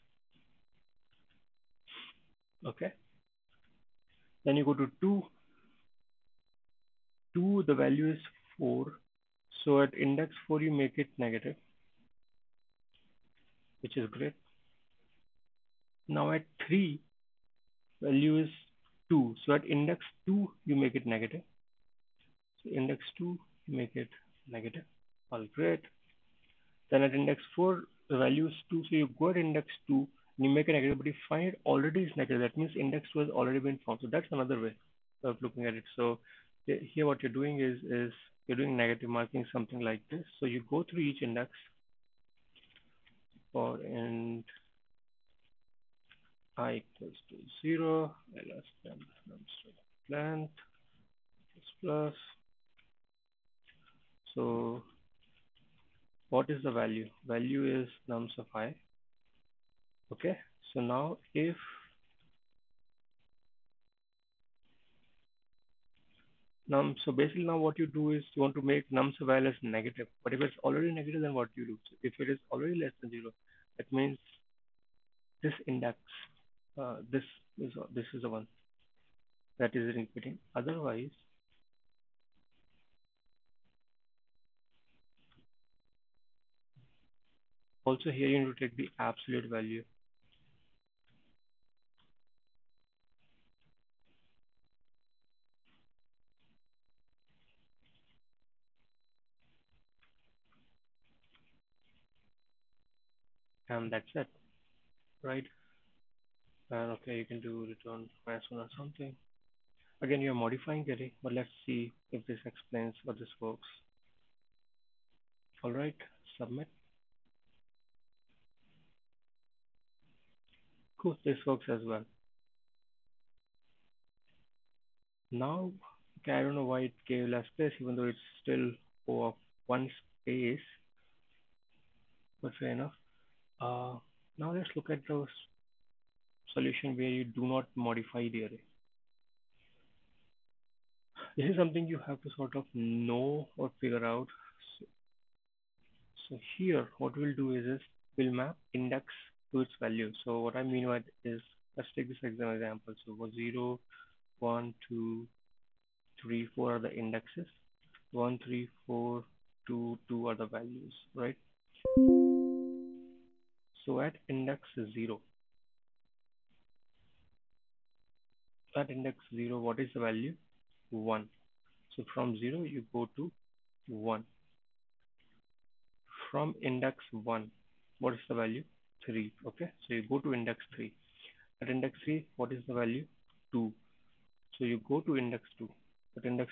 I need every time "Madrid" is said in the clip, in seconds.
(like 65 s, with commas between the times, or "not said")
not said.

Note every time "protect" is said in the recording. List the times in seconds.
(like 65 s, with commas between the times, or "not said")
not said.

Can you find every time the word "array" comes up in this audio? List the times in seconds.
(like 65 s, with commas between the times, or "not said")
138 s.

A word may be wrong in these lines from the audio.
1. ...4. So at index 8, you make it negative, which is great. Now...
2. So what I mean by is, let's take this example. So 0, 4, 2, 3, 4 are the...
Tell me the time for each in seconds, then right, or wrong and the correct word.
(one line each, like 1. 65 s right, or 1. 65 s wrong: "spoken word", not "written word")
1. 8 s wrong: "4", not "8"
2. 150 s wrong: "1", not "4".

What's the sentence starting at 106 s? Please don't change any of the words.
And okay, you can do return person or something.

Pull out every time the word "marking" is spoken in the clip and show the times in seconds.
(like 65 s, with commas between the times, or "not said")
39 s.